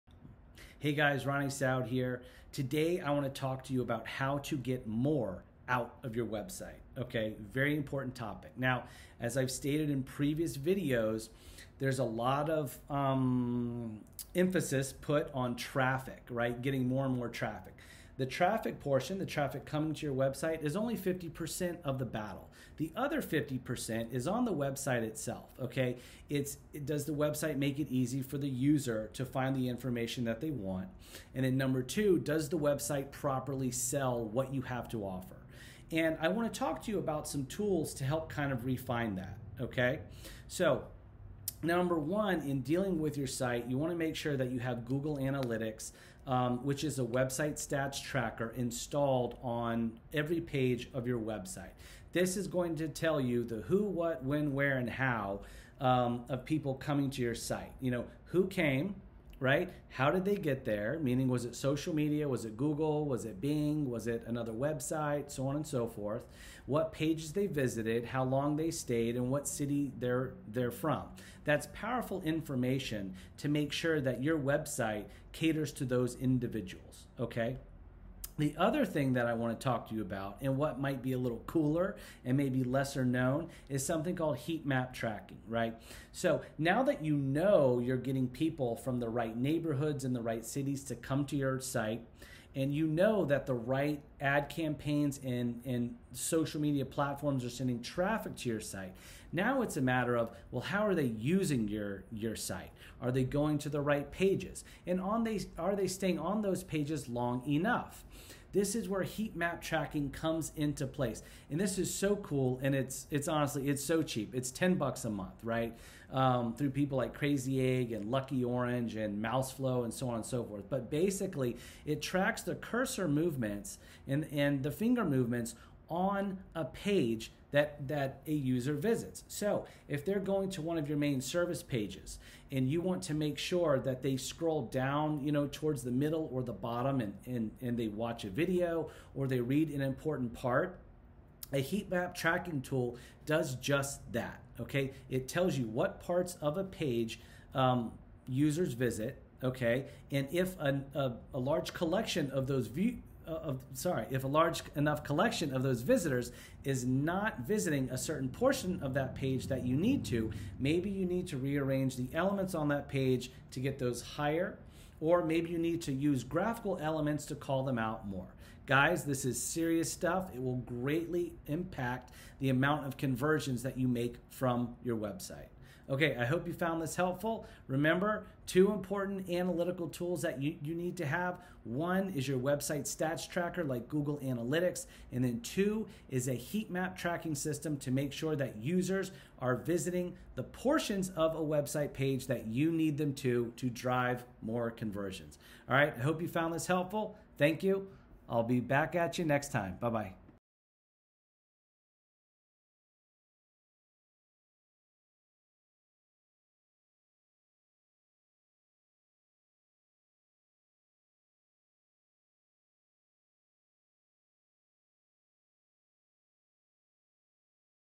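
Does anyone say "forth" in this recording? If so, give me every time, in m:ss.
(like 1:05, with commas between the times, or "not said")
1:05, 2:00.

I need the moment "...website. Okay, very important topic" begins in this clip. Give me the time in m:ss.
0:06.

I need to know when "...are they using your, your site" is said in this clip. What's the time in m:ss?
1:40.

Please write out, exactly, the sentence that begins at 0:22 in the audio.
The other 50% is on the website itself, okay?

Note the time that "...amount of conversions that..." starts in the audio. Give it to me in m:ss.
2:52.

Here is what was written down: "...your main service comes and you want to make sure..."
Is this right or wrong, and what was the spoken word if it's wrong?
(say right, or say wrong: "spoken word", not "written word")
wrong: "pages", not "comes".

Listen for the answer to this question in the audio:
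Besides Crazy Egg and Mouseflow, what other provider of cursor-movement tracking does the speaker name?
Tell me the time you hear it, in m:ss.
1:58.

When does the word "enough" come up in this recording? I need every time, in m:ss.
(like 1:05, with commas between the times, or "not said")
1:47, 2:34.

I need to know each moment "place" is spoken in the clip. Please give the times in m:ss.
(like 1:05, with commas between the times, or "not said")
1:50.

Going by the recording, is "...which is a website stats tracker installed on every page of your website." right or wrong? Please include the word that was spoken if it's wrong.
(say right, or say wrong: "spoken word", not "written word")
right.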